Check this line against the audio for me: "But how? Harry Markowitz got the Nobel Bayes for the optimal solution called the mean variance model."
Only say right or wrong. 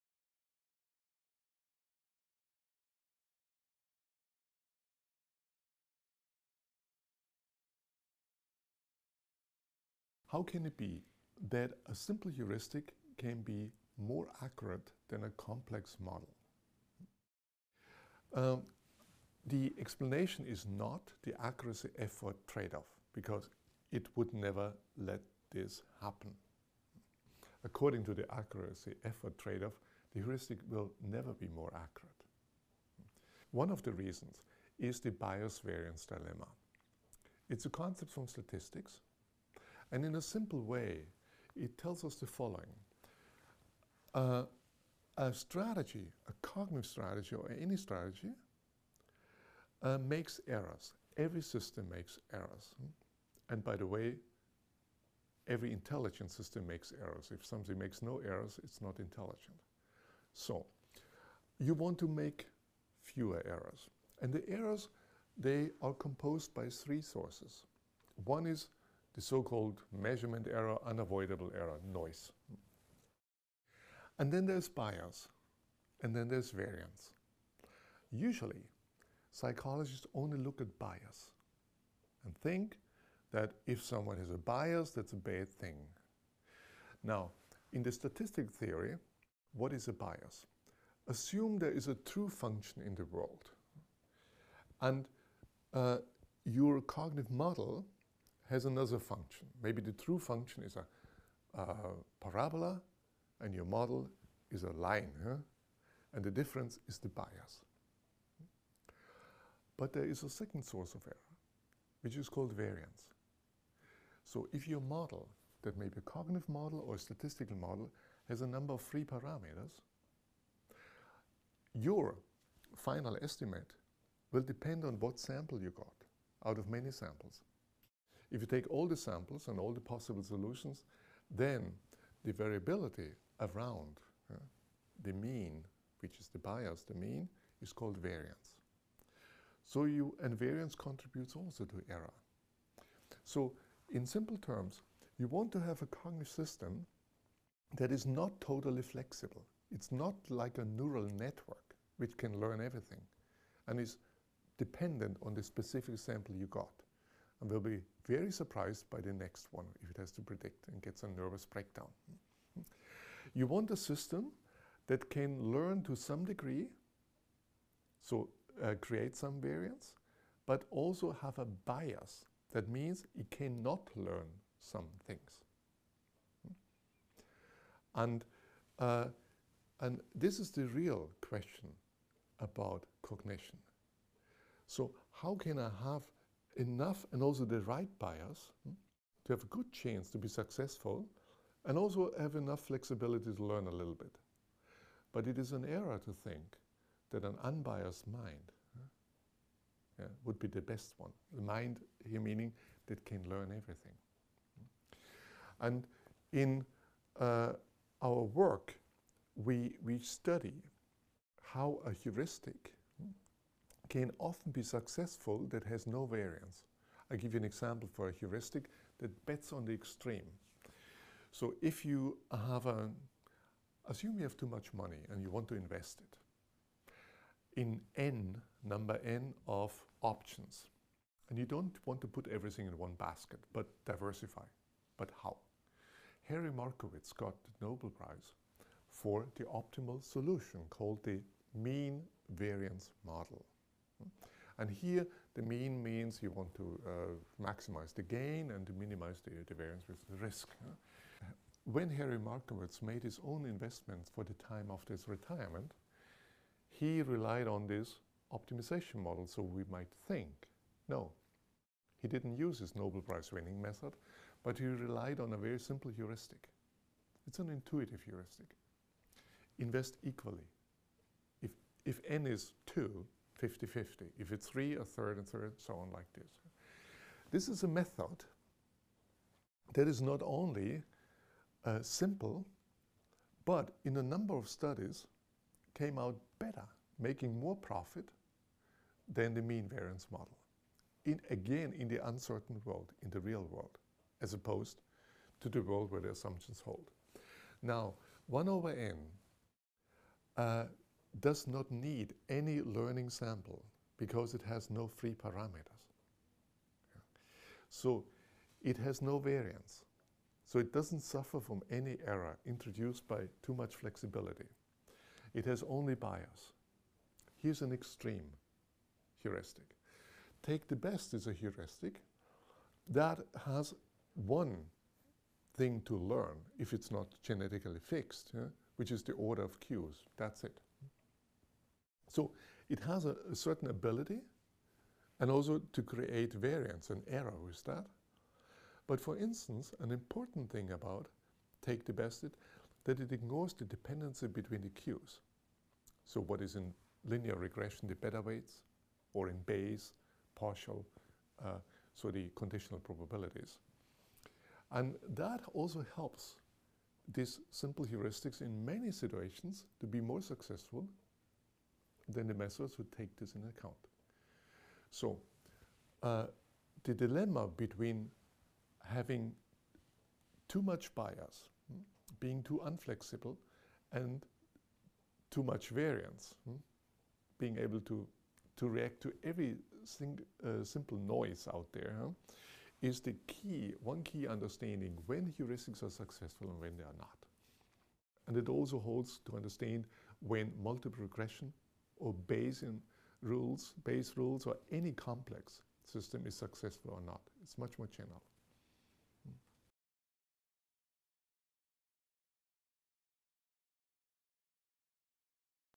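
wrong.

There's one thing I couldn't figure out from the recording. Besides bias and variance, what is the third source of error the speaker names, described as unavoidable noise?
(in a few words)
Measurement error.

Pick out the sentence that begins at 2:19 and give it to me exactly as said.
So you, and variance contributes also to error.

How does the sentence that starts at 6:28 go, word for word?
And it also holds to understand when multiple regression or Bayesian rules, Bayes rules, or any complex system is successful or not.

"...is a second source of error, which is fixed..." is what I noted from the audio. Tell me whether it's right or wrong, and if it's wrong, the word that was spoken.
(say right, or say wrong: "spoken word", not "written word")
wrong: "called", not "fixed".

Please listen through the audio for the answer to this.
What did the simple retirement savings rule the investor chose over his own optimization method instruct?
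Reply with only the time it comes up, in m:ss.
4:29.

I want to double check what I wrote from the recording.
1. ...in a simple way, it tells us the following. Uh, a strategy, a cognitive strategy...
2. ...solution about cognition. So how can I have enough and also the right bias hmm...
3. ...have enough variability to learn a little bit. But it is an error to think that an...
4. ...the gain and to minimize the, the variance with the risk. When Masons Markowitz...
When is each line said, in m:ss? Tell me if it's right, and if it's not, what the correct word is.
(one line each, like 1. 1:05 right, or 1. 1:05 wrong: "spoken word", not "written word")
1. 0:40 right
2. 3:01 wrong: "question", not "solution"
3. 3:12 wrong: "flexibility", not "variability"
4. 4:07 wrong: "Harry", not "Masons".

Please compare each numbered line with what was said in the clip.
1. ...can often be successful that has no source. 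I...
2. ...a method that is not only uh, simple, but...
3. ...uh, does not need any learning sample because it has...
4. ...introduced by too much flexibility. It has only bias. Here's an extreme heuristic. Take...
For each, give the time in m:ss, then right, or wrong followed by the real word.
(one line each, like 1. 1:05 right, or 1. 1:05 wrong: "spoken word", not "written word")
1. 3:33 wrong: "variance", not "source"
2. 4:37 right
3. 5:00 right
4. 5:12 right.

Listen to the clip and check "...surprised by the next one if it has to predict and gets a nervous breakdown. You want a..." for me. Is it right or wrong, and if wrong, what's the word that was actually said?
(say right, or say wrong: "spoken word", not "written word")
right.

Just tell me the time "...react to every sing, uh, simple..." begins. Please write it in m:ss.
6:18.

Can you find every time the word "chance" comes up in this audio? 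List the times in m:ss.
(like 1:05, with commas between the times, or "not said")
3:09.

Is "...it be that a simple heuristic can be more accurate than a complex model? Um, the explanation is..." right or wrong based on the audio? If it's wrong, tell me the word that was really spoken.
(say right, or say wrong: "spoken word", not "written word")
right.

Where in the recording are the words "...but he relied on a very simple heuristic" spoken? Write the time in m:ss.
4:24.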